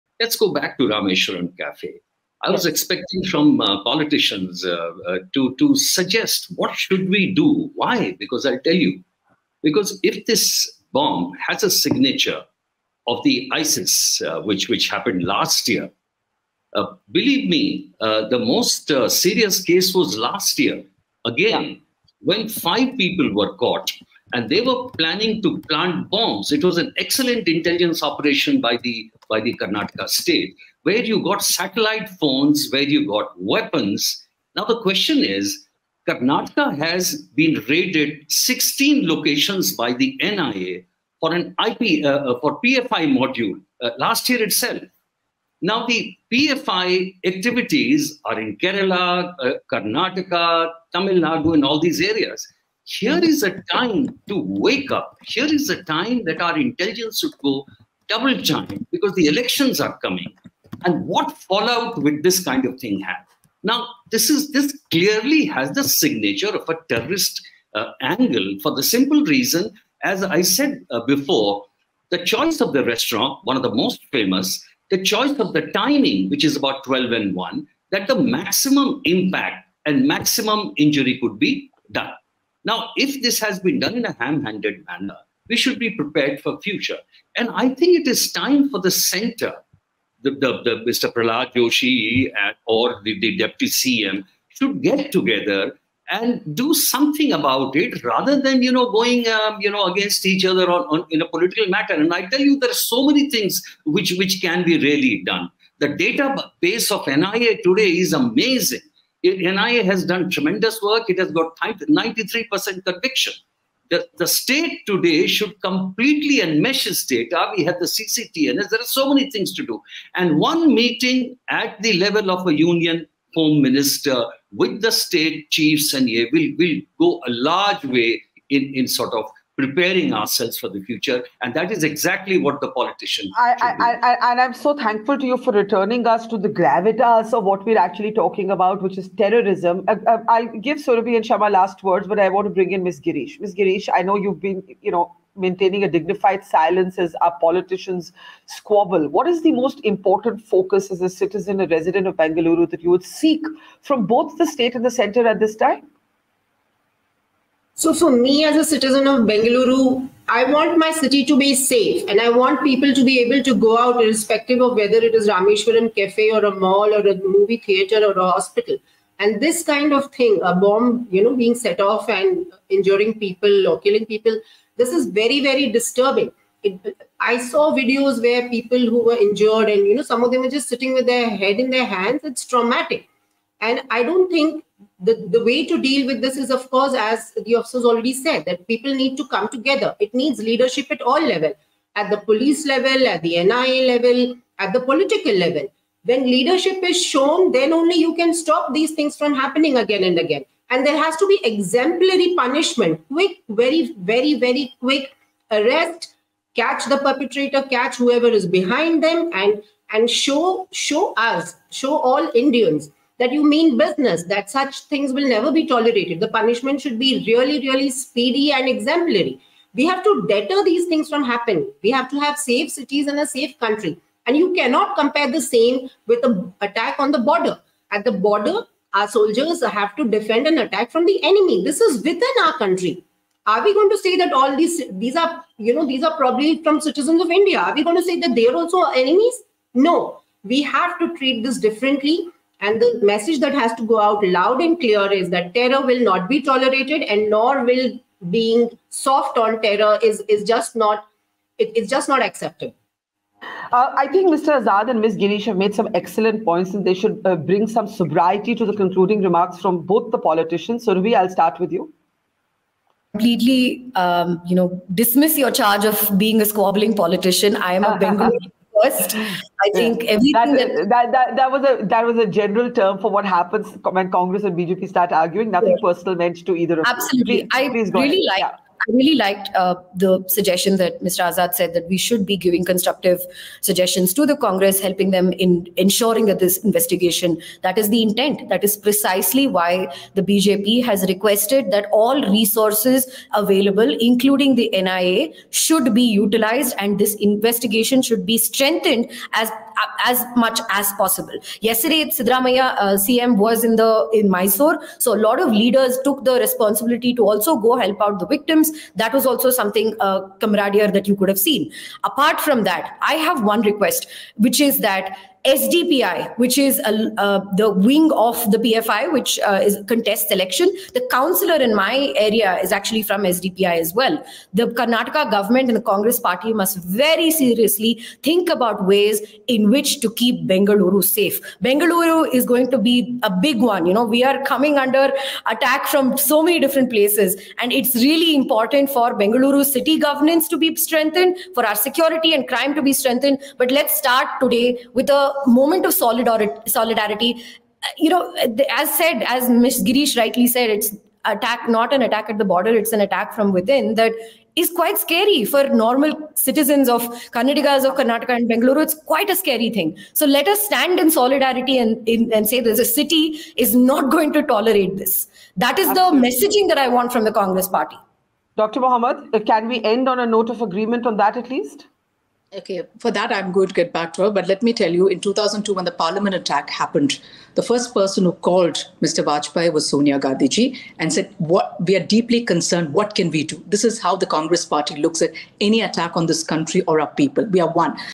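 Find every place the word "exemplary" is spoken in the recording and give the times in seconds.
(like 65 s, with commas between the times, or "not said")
201 s, 218 s.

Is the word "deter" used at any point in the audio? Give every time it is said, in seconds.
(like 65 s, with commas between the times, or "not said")
220 s.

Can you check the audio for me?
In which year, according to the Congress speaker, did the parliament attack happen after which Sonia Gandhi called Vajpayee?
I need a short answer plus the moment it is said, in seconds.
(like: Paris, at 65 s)
2002, at 375 s.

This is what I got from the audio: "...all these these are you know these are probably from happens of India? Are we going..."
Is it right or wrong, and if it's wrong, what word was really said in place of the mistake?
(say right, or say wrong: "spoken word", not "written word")
wrong: "citizens", not "happens".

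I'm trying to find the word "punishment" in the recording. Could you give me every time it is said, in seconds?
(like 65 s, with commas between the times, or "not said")
202 s, 216 s.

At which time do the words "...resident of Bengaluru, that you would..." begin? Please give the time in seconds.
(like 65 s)
151 s.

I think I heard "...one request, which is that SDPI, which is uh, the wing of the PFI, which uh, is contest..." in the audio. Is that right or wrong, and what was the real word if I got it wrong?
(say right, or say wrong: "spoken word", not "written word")
right.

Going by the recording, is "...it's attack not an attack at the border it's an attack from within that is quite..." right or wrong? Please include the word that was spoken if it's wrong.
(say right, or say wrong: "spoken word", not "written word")
right.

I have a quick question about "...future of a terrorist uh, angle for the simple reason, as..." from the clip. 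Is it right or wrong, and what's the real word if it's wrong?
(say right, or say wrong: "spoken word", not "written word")
wrong: "signature", not "future".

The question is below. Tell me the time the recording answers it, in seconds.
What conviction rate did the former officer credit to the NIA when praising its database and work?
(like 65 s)
111 s.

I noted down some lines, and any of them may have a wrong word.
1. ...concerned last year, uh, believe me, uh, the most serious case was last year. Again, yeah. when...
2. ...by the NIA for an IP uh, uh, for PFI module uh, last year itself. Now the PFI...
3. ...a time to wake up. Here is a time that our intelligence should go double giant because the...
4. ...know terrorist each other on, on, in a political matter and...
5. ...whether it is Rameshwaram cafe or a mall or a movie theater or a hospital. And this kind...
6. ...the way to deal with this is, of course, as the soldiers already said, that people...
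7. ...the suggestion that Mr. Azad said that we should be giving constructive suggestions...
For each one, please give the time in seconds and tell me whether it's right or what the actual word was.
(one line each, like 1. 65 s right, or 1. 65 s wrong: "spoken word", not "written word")
1. 14 s wrong: "happened", not "concerned"
2. 39 s right
3. 53 s right
4. 99 s wrong: "against", not "terrorist"
5. 164 s right
6. 185 s wrong: "officers", not "soldiers"
7. 279 s right.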